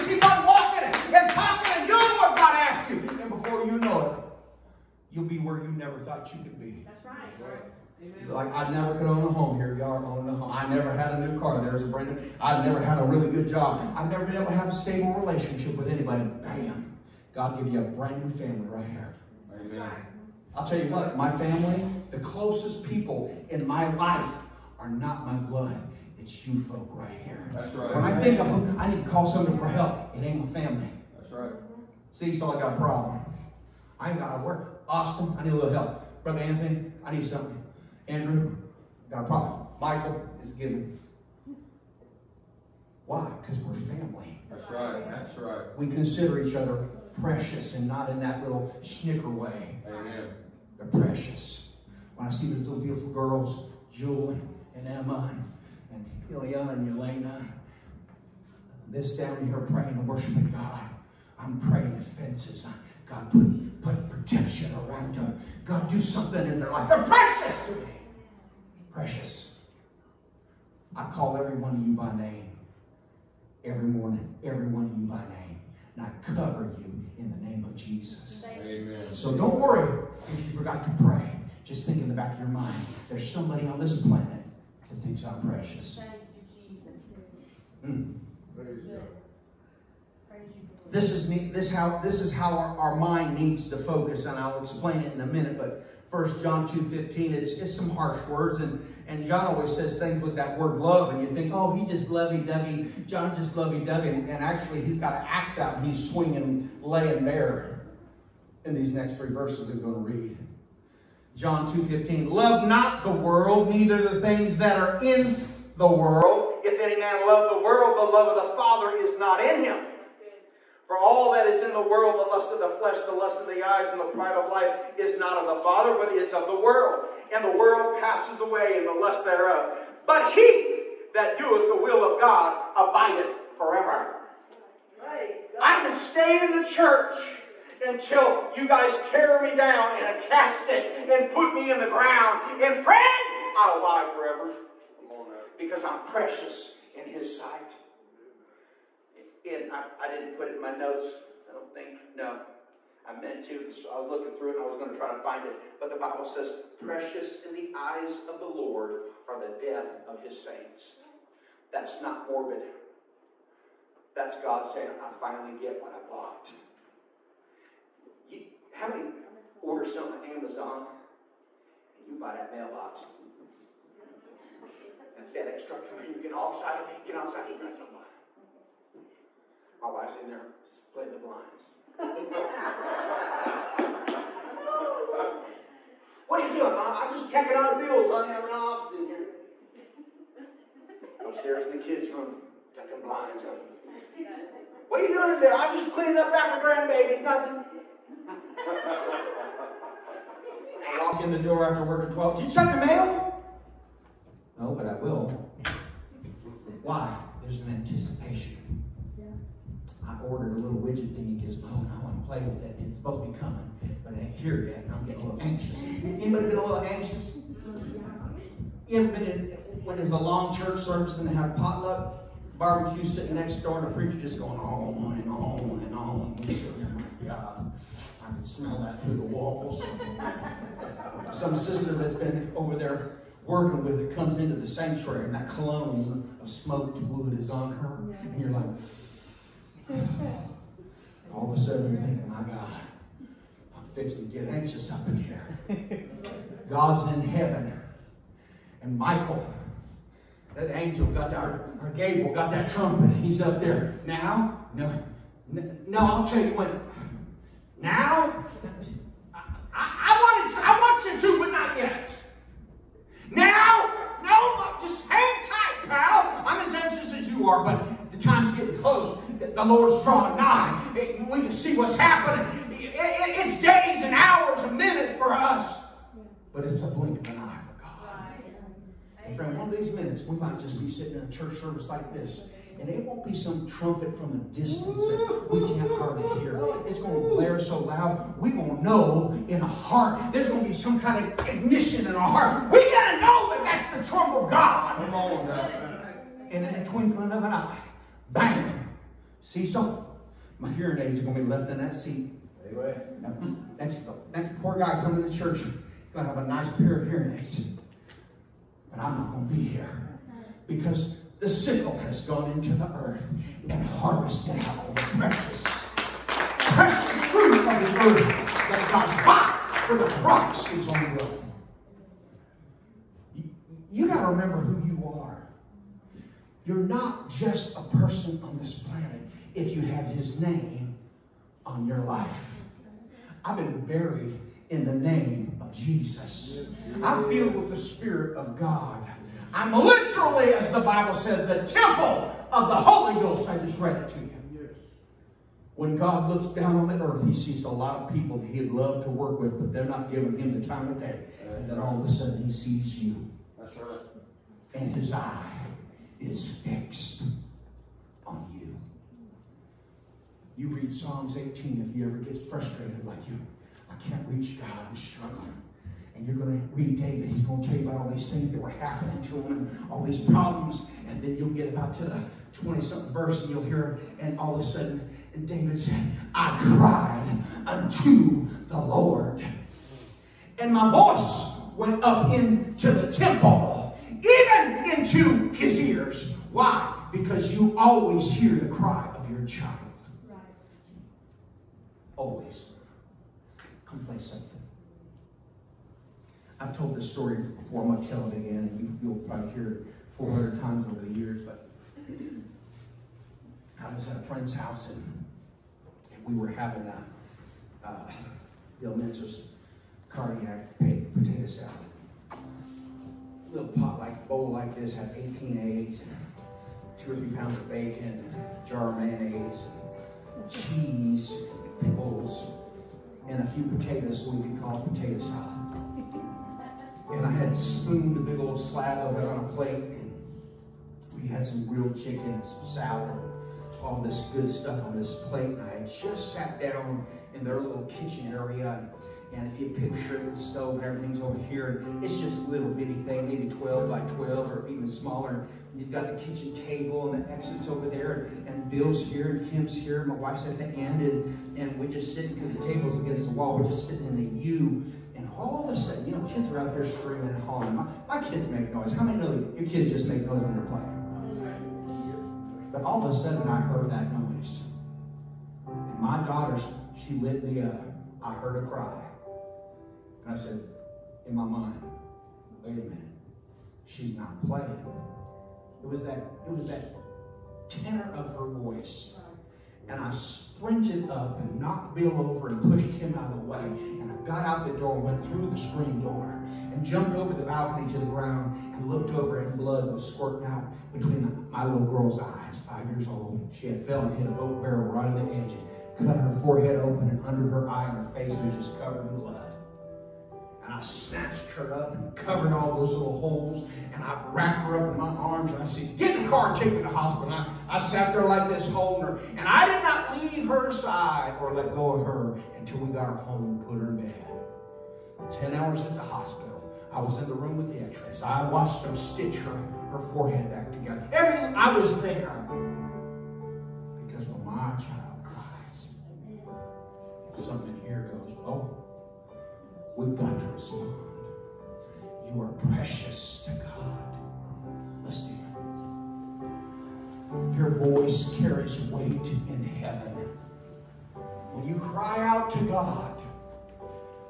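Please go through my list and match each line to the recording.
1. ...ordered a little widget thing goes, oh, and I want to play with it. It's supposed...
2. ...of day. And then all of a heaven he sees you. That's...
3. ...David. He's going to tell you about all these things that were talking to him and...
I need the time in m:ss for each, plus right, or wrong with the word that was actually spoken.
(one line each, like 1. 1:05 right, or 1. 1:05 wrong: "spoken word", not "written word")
1. 3:30 right
2. 5:50 wrong: "sudden", not "heaven"
3. 6:06 wrong: "happening", not "talking".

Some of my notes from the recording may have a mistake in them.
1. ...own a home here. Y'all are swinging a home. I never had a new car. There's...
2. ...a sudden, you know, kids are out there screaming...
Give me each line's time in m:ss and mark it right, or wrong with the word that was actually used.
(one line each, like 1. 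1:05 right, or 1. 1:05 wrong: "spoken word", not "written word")
1. 0:09 wrong: "owning", not "swinging"
2. 7:35 right.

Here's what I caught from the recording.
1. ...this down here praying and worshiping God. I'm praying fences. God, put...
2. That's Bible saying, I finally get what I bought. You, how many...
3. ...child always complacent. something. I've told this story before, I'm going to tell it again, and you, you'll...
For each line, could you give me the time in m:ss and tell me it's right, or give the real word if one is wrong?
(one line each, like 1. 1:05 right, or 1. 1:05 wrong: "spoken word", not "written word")
1. 0:58 right
2. 2:44 wrong: "God", not "Bible"
3. 6:29 right.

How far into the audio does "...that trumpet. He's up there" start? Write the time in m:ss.
4:12.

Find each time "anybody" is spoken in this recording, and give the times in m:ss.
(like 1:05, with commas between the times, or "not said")
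0:15, 3:36.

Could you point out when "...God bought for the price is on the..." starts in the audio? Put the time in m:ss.
5:18.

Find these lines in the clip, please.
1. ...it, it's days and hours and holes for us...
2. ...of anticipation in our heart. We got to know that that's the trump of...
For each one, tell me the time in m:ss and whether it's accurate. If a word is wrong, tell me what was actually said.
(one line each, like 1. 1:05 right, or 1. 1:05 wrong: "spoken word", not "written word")
1. 4:32 wrong: "minutes", not "holes"
2. 4:51 wrong: "ignition", not "anticipation".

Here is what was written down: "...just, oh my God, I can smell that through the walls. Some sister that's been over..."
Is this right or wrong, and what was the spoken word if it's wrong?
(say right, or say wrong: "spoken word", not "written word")
right.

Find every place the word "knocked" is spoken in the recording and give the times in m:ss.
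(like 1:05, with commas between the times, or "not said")
8:01.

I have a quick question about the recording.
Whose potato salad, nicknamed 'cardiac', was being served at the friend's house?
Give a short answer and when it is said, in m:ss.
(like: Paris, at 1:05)
Bill Menzo, at 6:48.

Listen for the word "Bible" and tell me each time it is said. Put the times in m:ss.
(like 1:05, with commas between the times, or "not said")
2:35, 5:40.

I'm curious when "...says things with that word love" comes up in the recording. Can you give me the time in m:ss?
1:39.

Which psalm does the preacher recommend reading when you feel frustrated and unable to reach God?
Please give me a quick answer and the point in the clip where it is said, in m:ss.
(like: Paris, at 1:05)
Psalm 18, at 6:00.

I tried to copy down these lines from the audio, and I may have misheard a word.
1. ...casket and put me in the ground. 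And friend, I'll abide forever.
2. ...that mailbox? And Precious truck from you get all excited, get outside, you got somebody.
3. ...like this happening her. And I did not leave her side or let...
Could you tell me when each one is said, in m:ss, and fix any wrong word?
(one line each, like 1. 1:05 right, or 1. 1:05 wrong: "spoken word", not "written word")
1. 2:20 right
2. 2:52 wrong: "FedEx", not "Precious"
3. 8:28 wrong: "holding", not "happening".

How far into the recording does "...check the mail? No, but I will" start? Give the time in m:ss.
3:22.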